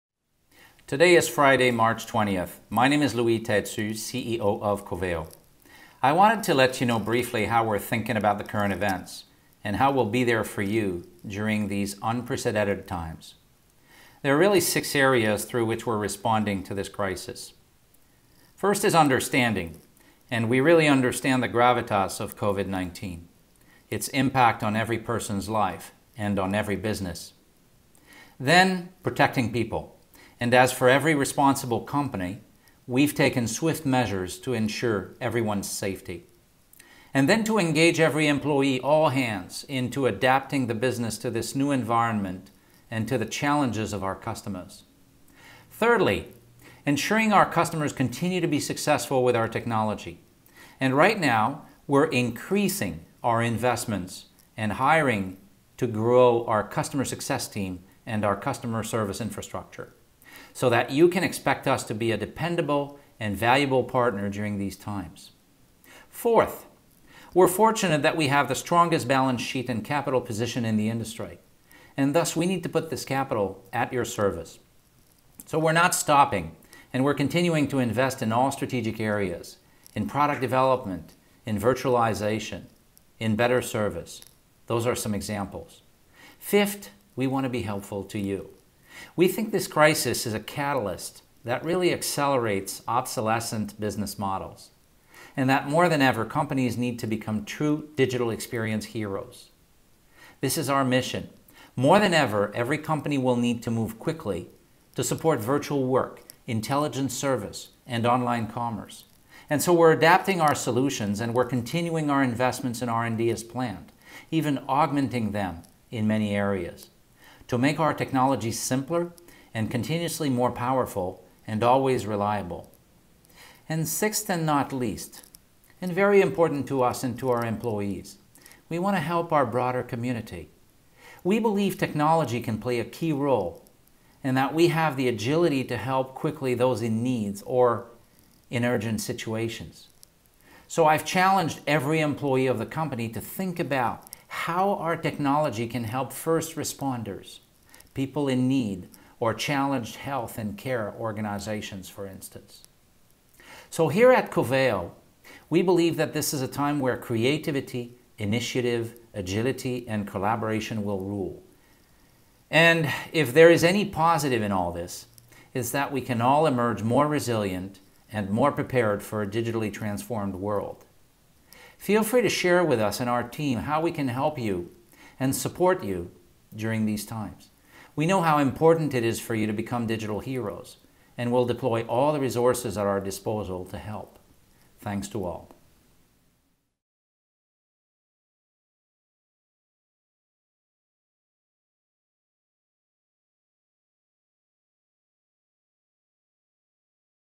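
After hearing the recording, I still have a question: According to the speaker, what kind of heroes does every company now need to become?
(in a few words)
Digital experience heroes.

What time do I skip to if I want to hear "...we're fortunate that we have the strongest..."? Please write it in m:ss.
1:07.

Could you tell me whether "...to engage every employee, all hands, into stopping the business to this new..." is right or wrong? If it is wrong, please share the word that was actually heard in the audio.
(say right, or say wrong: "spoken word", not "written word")
wrong: "adapting", not "stopping".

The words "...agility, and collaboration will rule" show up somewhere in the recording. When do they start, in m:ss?
2:39.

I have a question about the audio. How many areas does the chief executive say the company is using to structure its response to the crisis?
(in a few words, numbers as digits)
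6.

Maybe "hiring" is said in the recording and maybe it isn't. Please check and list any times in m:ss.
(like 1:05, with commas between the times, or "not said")
0:54.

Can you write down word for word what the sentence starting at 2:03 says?
And sixth and not least, and very important to us and to our employees, we want to help our broader community.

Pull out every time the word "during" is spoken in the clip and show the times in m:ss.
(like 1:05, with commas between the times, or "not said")
0:11, 1:04, 2:56.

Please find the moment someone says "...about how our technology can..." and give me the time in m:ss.
2:23.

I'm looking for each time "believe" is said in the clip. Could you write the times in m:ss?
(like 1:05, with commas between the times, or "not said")
2:11, 2:35.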